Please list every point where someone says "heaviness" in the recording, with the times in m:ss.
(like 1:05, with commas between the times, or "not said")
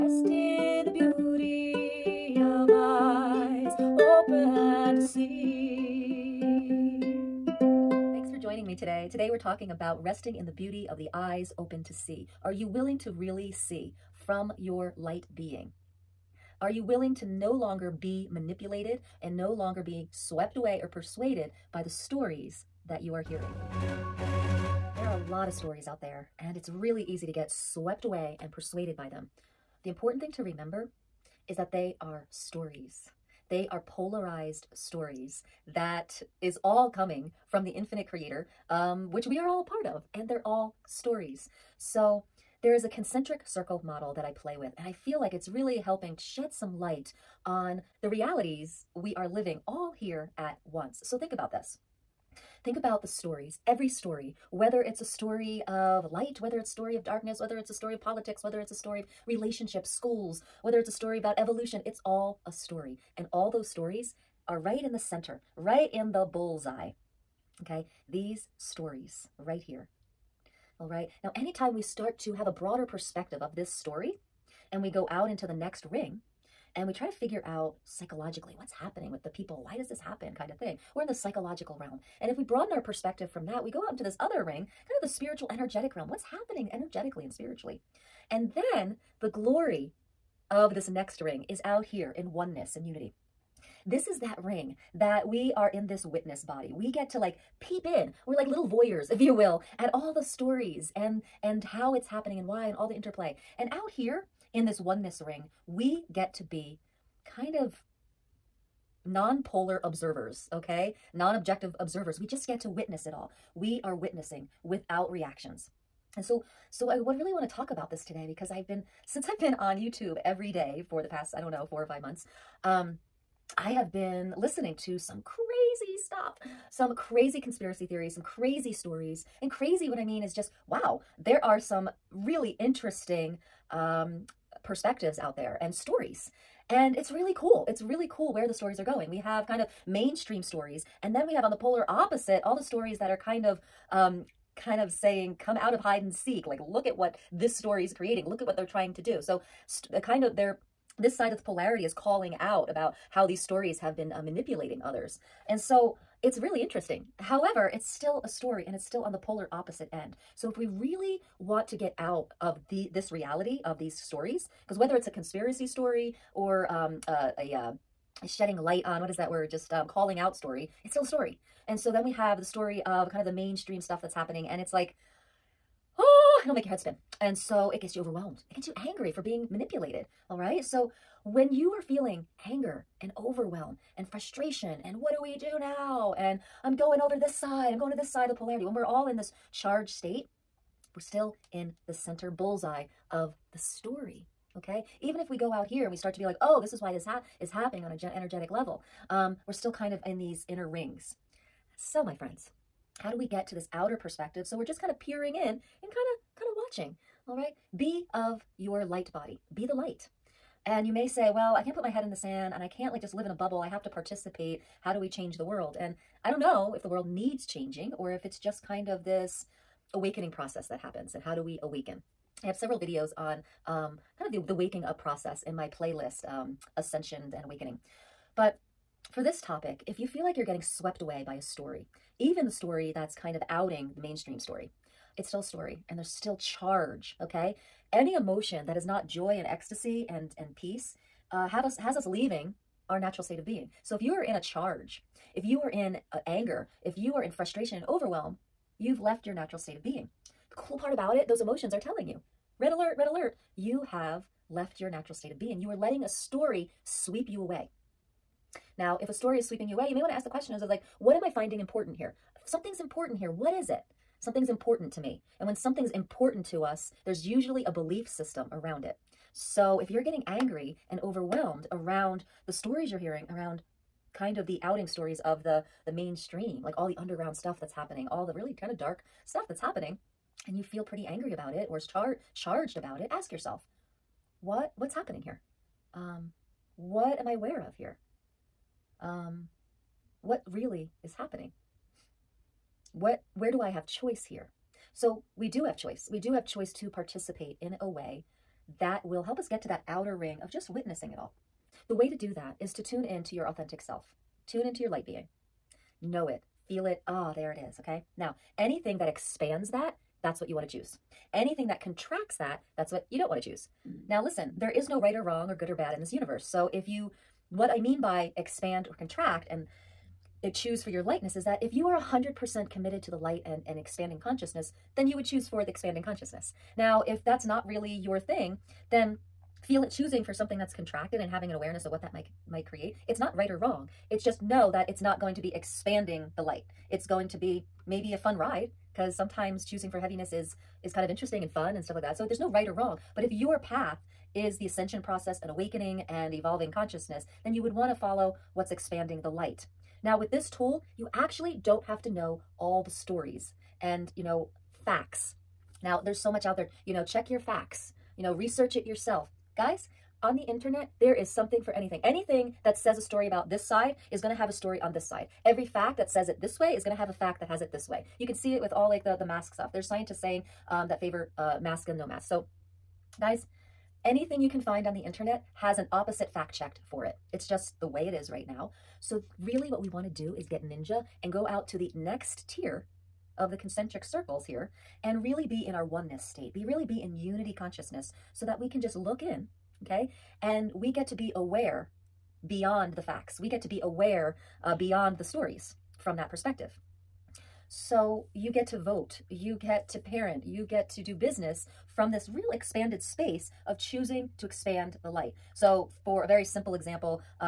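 5:39.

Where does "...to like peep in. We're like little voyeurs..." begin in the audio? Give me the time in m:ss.
1:37.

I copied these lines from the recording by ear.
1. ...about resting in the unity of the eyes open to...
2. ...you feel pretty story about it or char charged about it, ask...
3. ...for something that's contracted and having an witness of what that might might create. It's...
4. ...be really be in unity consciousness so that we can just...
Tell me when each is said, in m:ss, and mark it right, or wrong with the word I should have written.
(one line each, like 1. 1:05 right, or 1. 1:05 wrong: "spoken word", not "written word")
1. 0:09 wrong: "beauty", not "unity"
2. 4:40 wrong: "angry", not "story"
3. 5:30 wrong: "awareness", not "witness"
4. 6:26 right.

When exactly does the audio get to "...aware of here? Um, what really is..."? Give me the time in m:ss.
4:47.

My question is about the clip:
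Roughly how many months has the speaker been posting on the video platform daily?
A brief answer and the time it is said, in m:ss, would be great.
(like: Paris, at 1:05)
four or five months, at 2:01.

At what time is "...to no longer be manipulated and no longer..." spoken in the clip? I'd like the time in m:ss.
0:17.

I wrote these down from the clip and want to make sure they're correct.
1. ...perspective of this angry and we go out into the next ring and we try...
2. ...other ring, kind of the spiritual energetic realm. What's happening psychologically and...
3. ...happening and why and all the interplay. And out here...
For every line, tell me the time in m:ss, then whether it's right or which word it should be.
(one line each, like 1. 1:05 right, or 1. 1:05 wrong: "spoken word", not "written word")
1. 1:12 wrong: "story", not "angry"
2. 1:24 wrong: "energetically", not "psychologically"
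3. 1:42 right.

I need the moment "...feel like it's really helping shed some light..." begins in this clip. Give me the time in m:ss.
0:44.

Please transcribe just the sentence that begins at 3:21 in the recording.
So my friends, how do we get to this outer perspective?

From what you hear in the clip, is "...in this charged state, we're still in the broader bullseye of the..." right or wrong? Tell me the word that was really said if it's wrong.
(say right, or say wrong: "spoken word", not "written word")
wrong: "center", not "broader".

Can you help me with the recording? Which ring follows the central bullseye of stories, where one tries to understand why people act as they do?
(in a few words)
Psychological realm.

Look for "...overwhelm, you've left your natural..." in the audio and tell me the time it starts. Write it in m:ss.
4:07.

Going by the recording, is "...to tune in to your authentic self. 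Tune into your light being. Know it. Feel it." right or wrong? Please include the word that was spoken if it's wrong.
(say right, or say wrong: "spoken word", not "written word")
right.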